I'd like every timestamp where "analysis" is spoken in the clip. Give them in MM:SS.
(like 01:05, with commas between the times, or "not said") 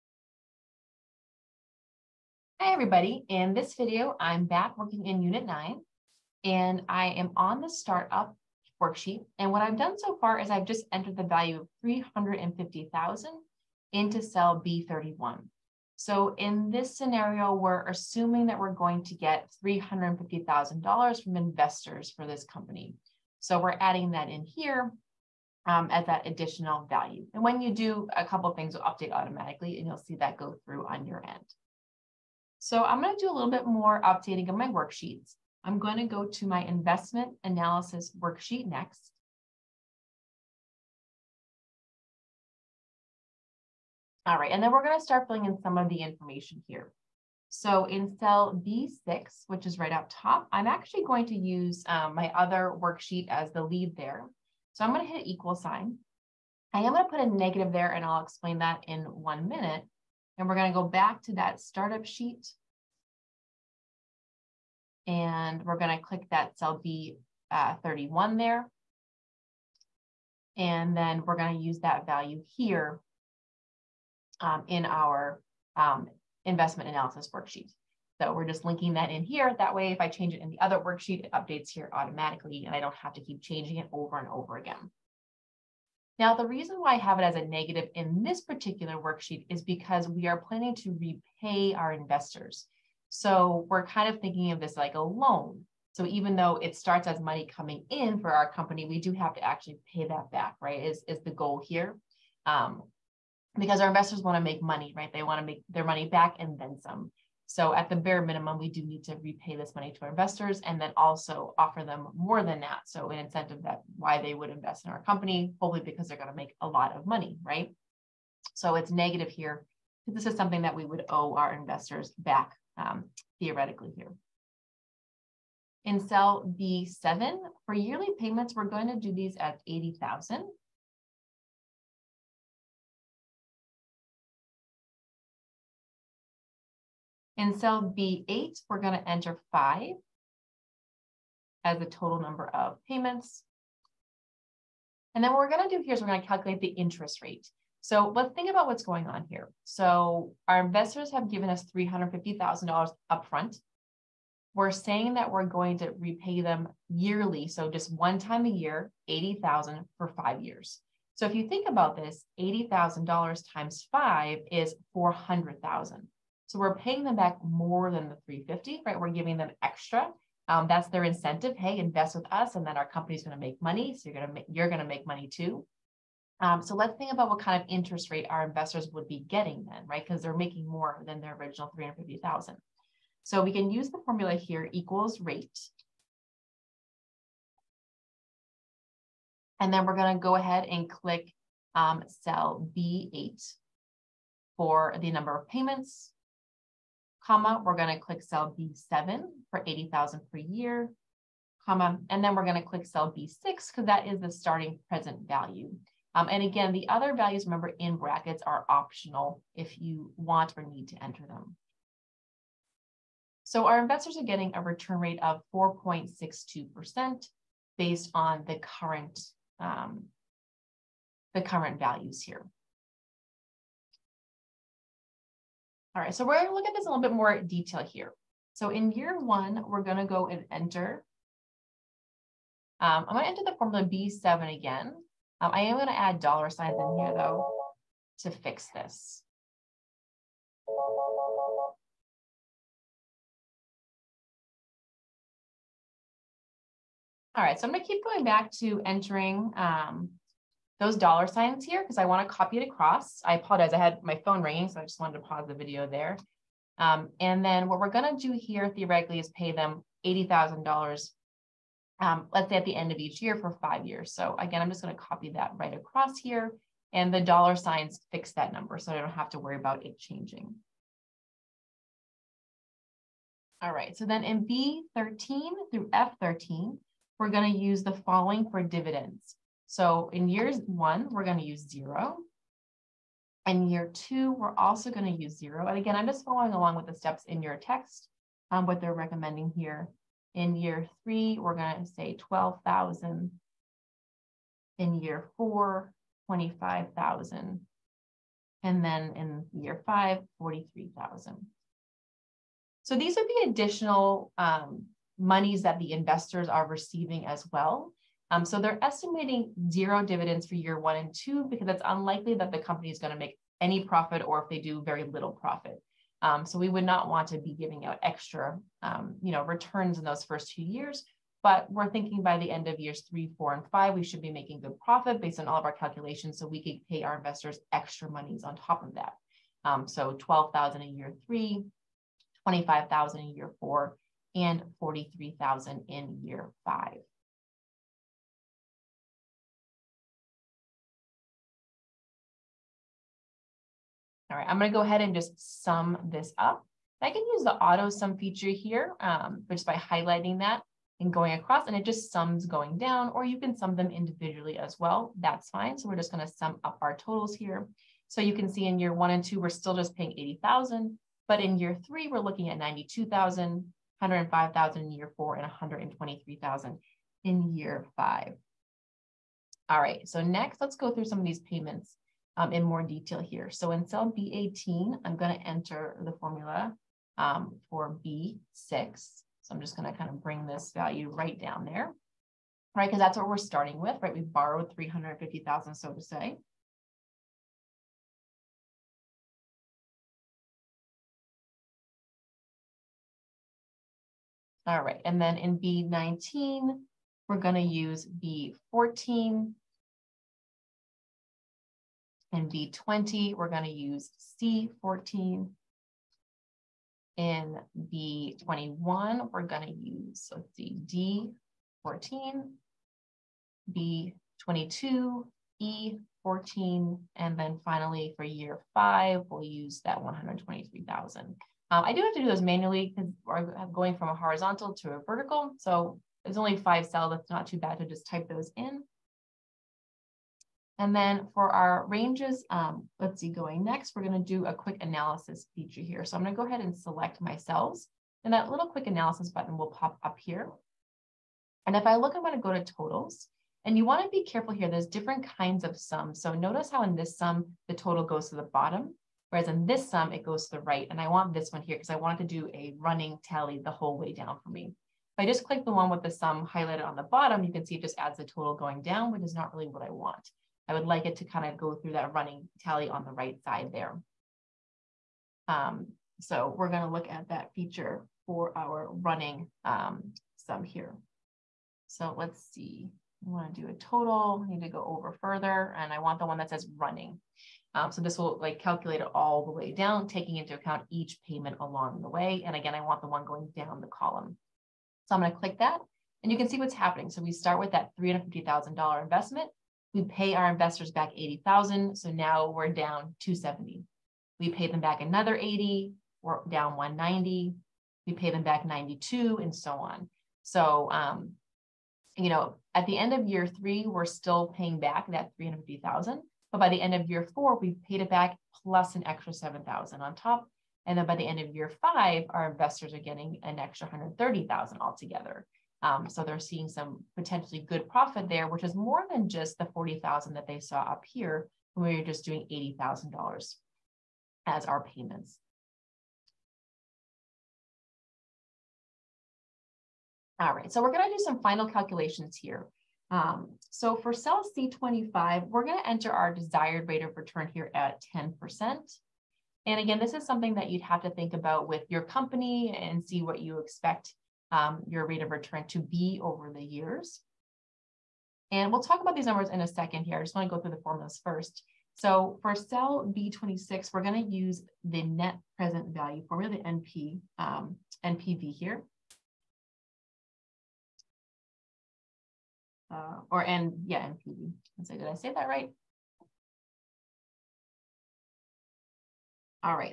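00:37, 01:16, 07:14, 07:18.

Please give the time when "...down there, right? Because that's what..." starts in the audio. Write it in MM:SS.
06:21.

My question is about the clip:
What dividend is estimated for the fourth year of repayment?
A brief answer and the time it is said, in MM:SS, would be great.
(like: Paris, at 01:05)
25,000, at 04:56.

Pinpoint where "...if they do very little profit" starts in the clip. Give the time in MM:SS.
05:14.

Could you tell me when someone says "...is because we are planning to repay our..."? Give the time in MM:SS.
01:29.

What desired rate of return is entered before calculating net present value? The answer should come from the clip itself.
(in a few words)
10%.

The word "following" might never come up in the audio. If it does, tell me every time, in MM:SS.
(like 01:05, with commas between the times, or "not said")
04:37, 04:46.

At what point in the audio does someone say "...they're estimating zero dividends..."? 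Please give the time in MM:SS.
05:08.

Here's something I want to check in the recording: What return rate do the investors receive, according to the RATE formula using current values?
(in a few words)
4.62%.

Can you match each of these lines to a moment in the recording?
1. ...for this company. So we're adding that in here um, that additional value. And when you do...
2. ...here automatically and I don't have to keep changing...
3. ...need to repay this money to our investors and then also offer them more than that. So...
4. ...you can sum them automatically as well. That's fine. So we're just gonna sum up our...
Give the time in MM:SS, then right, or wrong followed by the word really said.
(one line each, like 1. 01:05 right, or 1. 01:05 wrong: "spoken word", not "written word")
1. 00:22 right
2. 01:21 right
3. 01:48 right
4. 05:53 wrong: "individually", not "automatically".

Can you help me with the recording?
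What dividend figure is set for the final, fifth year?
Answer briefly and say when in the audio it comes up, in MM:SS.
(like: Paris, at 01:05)
43,000, at 05:00.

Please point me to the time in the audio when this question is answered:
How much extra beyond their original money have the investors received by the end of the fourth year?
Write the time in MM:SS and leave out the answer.
08:29.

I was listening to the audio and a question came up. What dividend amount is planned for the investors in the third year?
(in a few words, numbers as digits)
12,000.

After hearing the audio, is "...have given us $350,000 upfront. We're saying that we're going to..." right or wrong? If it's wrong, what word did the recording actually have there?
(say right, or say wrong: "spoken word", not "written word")
right.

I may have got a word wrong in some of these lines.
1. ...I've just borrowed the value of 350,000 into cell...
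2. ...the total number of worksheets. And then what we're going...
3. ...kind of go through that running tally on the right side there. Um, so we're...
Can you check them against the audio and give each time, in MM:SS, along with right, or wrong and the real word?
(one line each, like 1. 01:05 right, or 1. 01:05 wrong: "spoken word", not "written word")
1. 00:10 wrong: "entered", not "borrowed"
2. 02:21 wrong: "payments", not "worksheets"
3. 07:41 right.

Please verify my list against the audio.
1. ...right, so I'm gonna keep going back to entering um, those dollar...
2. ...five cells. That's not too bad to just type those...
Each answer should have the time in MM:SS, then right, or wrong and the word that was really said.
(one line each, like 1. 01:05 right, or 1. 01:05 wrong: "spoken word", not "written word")
1. 04:07 right
2. 07:06 right.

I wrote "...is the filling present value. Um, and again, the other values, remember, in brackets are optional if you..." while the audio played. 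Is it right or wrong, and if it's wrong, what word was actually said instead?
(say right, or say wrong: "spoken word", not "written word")
wrong: "starting", not "filling".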